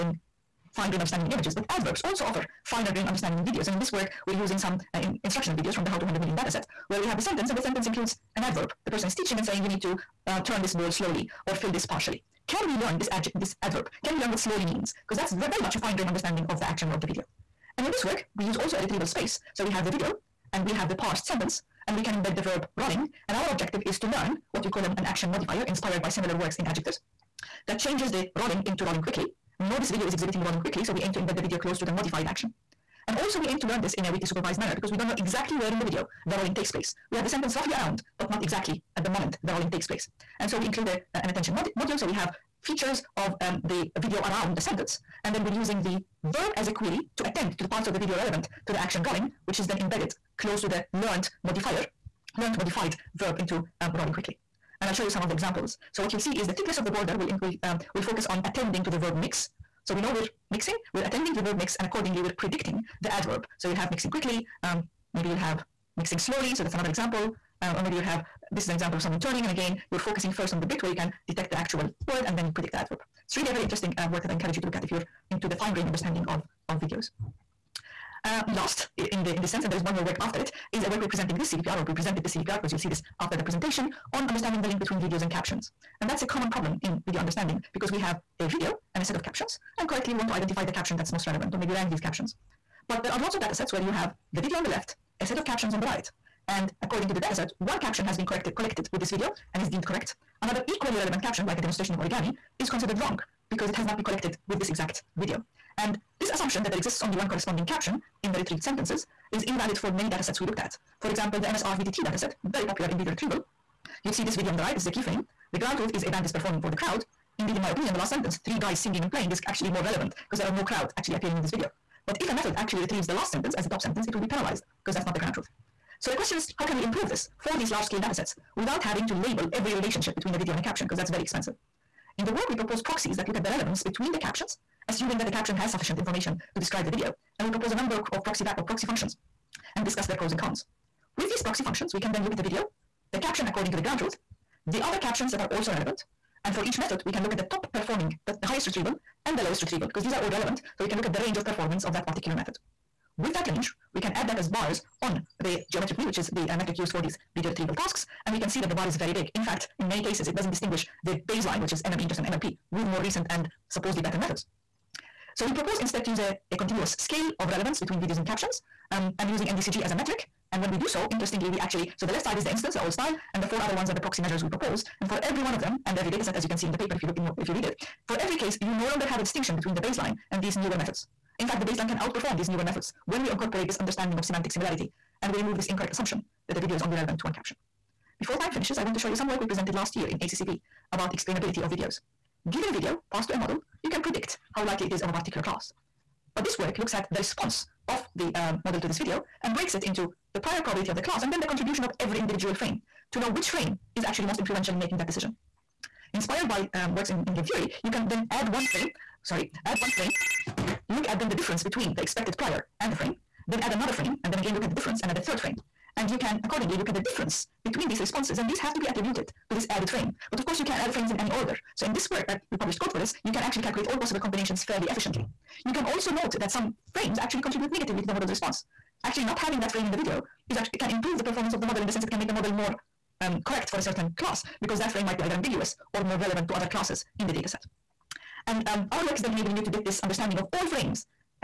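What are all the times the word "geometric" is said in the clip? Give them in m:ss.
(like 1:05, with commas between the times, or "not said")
2:35.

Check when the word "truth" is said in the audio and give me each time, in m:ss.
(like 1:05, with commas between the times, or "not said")
1:55, 2:05, 2:23.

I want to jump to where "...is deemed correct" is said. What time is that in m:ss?
1:39.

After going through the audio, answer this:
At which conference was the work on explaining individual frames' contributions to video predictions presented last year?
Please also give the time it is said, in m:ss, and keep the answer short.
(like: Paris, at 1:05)
ACCV, at 3:10.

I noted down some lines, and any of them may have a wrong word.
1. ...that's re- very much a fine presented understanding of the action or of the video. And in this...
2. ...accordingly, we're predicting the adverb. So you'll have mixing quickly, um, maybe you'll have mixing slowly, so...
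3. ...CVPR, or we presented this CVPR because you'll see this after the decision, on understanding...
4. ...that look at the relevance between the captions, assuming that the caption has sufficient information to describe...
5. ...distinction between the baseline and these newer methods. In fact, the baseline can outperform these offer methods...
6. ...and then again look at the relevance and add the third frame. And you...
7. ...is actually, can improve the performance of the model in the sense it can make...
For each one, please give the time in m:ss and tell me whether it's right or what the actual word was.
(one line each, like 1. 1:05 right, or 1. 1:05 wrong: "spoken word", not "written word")
1. 0:15 wrong: "grained", not "presented"
2. 1:01 right
3. 1:21 wrong: "presentation", not "decision"
4. 2:13 right
5. 2:59 wrong: "newer", not "offer"
6. 3:34 wrong: "difference", not "relevance"
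7. 3:50 right.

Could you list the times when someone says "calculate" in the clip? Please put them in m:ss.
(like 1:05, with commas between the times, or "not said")
3:43.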